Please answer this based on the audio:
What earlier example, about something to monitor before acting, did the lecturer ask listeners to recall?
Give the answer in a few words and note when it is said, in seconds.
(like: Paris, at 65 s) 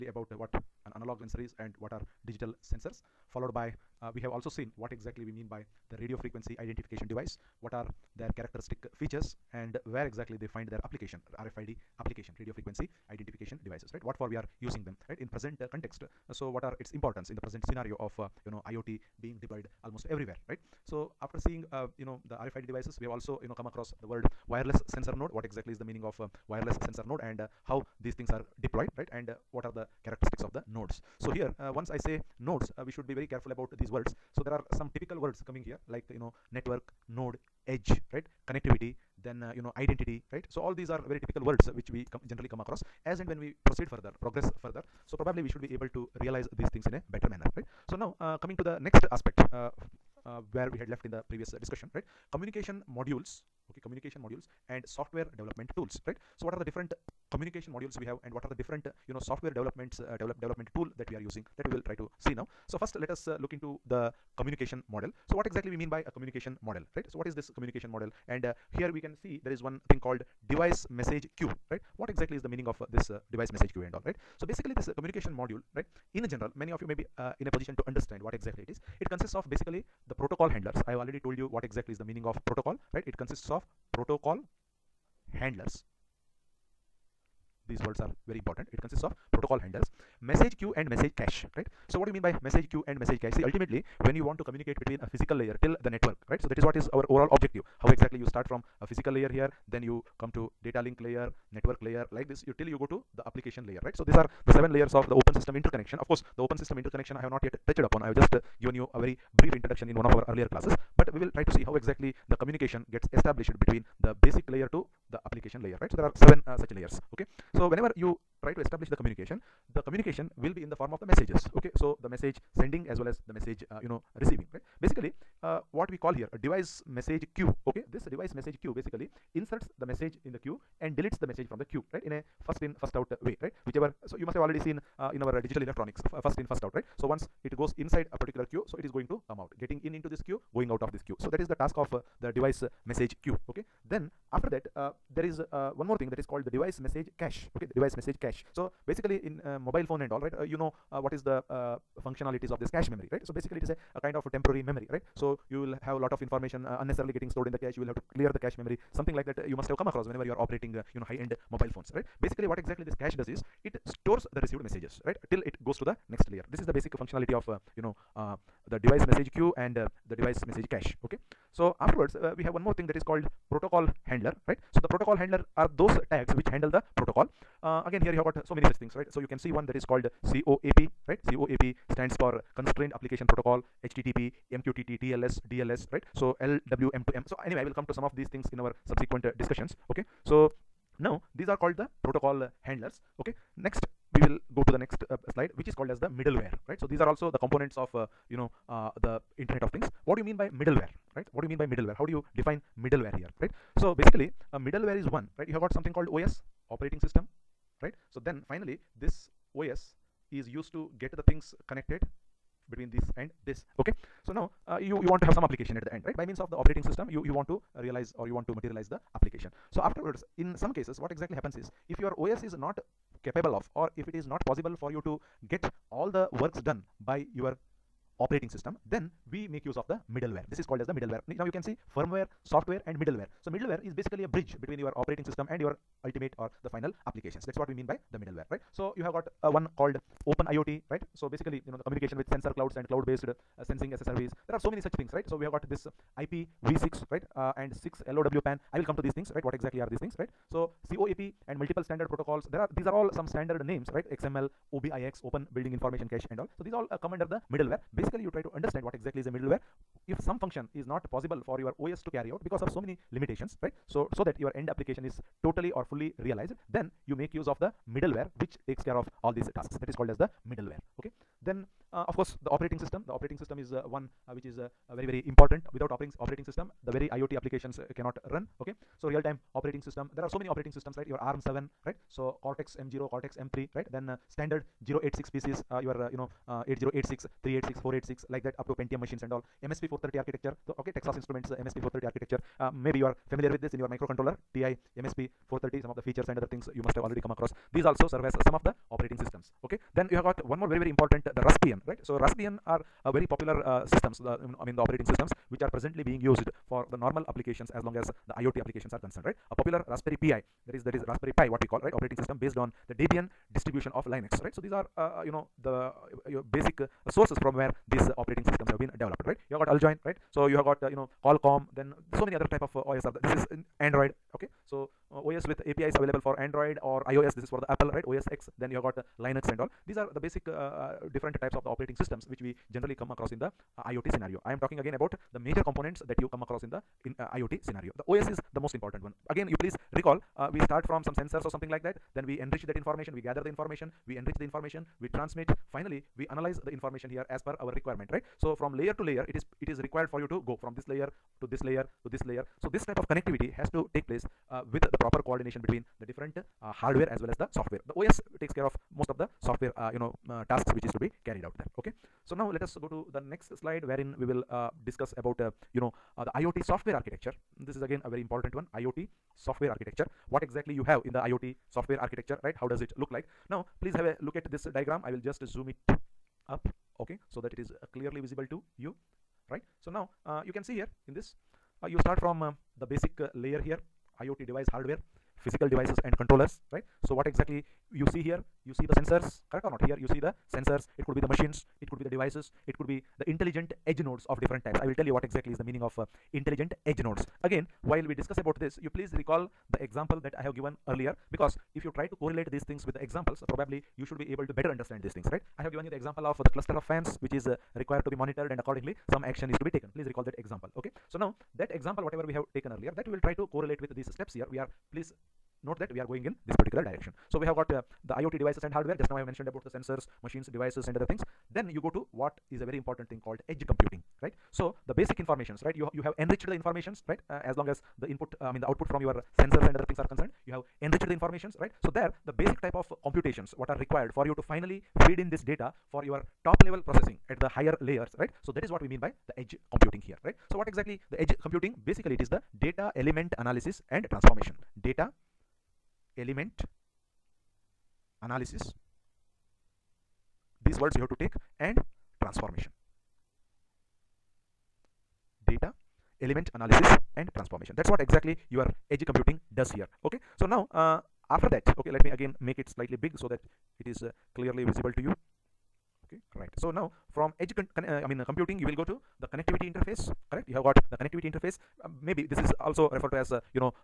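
Cluster of fans, at 406 s.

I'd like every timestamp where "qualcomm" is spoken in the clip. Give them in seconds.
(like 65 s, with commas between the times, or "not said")
321 s.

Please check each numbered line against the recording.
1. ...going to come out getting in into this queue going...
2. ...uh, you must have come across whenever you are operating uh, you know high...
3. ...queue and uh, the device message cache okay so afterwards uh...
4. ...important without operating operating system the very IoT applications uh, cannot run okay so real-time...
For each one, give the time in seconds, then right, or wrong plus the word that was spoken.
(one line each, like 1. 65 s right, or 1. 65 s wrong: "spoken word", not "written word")
1. 138 s right
2. 159 s right
3. 169 s right
4. 275 s right.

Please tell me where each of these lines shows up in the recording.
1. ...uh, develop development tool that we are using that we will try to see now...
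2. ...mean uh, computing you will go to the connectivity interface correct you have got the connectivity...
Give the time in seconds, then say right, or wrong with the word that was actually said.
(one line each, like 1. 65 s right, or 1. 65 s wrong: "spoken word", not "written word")
1. 59 s right
2. 468 s right.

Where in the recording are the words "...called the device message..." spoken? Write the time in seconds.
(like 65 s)
146 s.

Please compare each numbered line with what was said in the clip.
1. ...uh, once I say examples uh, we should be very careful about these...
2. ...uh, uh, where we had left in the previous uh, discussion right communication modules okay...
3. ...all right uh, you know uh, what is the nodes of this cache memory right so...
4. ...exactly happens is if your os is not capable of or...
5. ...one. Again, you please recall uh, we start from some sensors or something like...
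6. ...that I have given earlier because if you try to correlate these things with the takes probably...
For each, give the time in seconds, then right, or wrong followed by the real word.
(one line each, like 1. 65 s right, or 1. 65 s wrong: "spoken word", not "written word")
1. 31 s wrong: "nodes", not "examples"
2. 49 s right
3. 150 s wrong: "functionalities", not "nodes"
4. 221 s right
5. 339 s right
6. 400 s wrong: "examples", not "takes".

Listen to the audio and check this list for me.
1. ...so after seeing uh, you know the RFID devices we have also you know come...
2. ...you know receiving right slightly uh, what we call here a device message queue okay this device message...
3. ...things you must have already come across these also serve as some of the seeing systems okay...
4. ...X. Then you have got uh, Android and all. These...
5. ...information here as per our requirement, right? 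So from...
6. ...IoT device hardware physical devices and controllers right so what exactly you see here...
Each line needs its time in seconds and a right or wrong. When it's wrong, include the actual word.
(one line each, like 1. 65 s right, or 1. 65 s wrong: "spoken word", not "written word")
1. 20 s right
2. 123 s wrong: "basically", not "slightly"
3. 296 s wrong: "operating", not "seeing"
4. 328 s wrong: "Linux", not "Android"
5. 346 s right
6. 384 s right.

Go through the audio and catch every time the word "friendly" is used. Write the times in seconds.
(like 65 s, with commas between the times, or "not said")
not said.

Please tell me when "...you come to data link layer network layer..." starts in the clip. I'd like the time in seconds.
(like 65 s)
99 s.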